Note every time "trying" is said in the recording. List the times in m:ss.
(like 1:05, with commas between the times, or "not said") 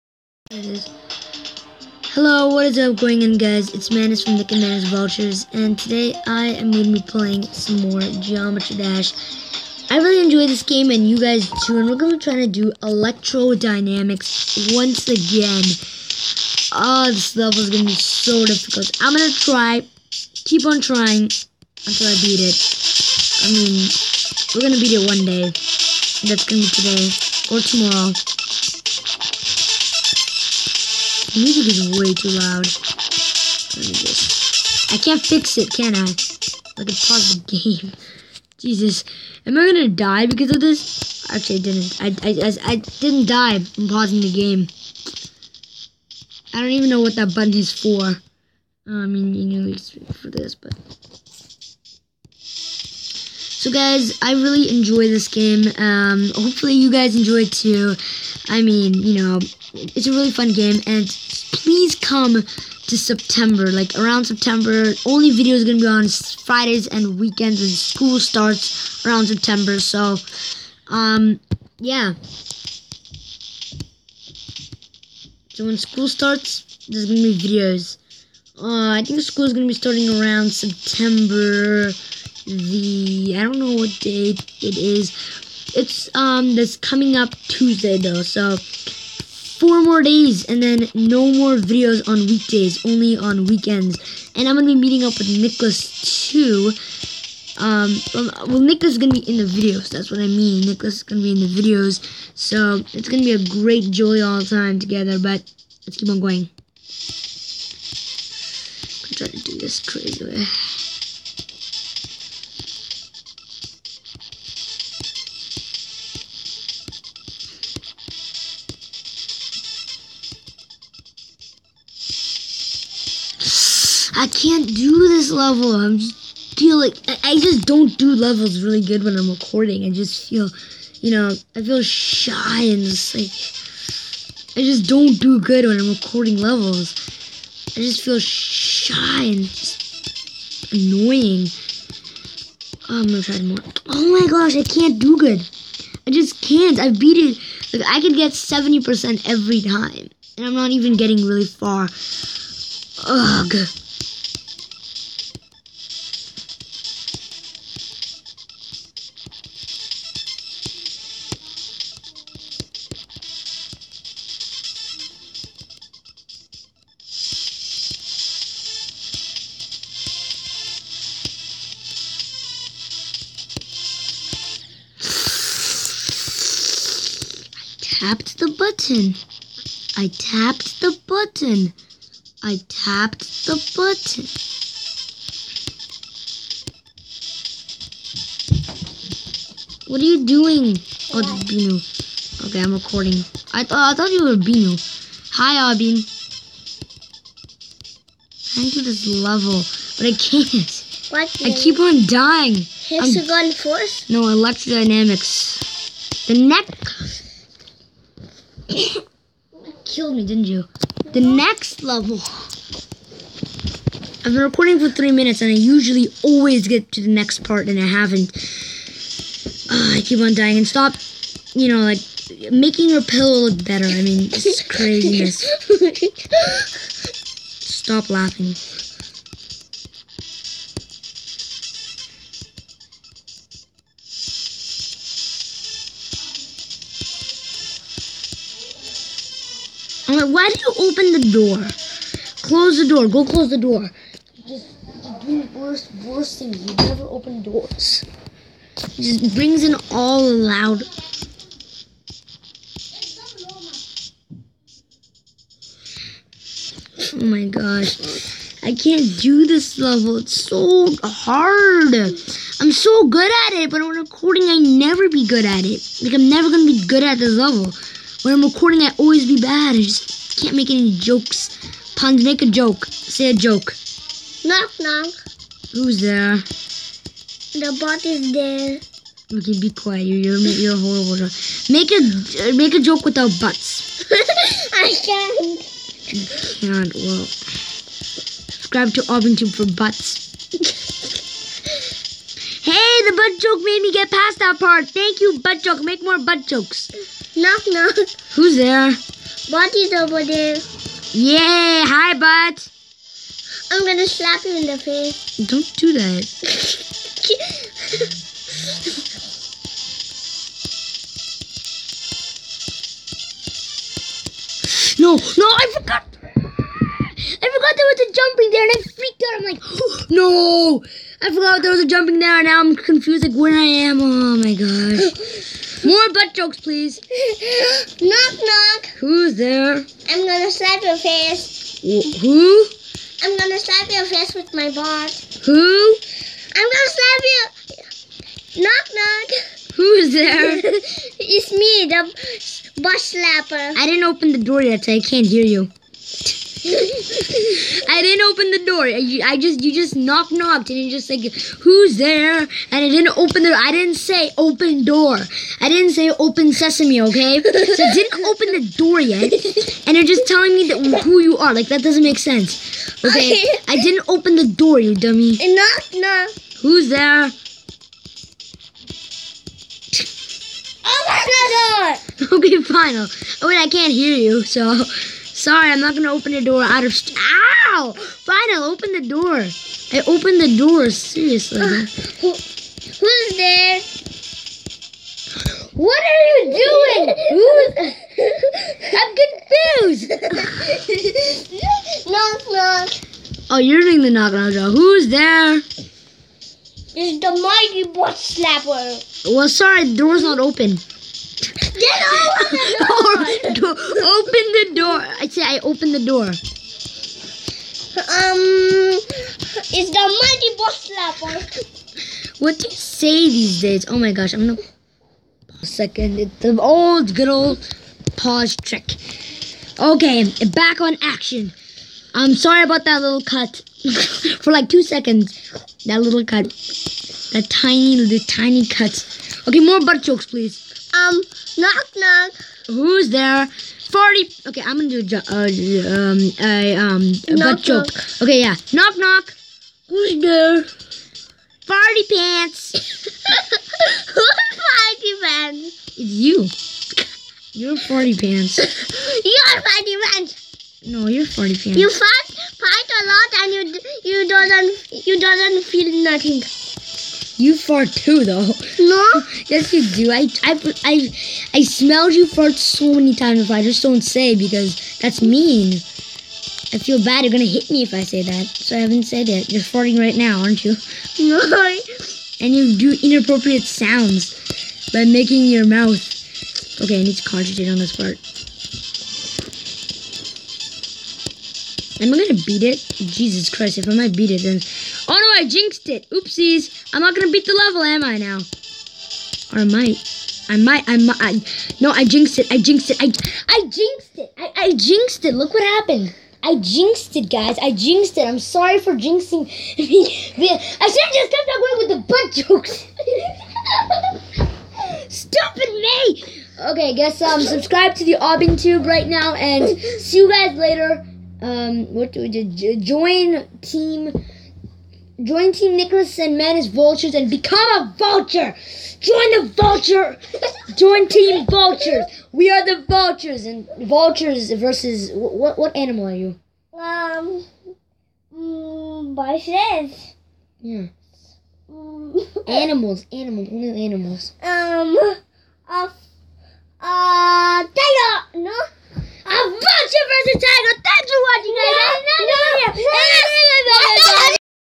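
0:12, 0:20.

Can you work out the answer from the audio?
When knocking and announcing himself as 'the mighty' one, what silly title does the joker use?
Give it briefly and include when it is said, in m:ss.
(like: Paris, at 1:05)
the mighty butt slapper, at 6:36.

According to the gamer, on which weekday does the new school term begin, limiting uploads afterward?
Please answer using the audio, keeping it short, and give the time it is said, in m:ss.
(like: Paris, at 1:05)
Tuesday, at 1:27.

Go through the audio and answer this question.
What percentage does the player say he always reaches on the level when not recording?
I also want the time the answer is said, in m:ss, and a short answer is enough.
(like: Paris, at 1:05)
70%, at 2:28.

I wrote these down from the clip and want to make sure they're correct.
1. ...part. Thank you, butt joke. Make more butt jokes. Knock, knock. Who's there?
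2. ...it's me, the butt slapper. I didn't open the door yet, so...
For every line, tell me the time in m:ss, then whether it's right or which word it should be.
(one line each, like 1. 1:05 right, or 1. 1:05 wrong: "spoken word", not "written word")
1. 4:54 right
2. 5:41 right.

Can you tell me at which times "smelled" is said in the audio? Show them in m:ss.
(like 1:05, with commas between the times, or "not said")
7:41.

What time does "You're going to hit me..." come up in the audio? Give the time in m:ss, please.
7:47.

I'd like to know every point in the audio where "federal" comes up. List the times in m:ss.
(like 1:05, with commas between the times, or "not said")
not said.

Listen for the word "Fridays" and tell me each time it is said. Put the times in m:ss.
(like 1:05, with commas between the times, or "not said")
1:06.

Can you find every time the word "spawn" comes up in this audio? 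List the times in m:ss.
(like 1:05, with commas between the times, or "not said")
not said.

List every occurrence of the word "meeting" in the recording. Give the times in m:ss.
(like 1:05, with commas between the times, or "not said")
1:34.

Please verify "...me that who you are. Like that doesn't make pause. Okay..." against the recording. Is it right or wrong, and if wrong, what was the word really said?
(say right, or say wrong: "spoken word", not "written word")
wrong: "sense", not "pause".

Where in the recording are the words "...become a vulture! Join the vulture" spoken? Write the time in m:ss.
8:37.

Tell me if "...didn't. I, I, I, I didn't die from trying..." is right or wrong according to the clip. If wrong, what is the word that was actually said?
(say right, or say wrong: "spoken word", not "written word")
wrong: "pausing", not "trying".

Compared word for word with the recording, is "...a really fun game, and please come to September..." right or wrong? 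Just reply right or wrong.
right.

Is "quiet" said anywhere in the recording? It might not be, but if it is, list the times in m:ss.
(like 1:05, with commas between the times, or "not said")
4:39.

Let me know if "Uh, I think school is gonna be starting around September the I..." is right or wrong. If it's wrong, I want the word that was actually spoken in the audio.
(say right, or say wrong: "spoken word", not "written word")
right.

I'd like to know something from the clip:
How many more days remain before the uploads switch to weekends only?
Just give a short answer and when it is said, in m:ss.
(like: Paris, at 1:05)
4, at 1:29.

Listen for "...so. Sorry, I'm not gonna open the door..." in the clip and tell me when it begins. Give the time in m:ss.
6:14.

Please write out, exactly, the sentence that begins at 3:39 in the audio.
Uh, I keep on dying and stop, you know, like making your pillow look better.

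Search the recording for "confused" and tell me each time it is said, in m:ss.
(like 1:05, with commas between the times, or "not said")
5:22, 6:30.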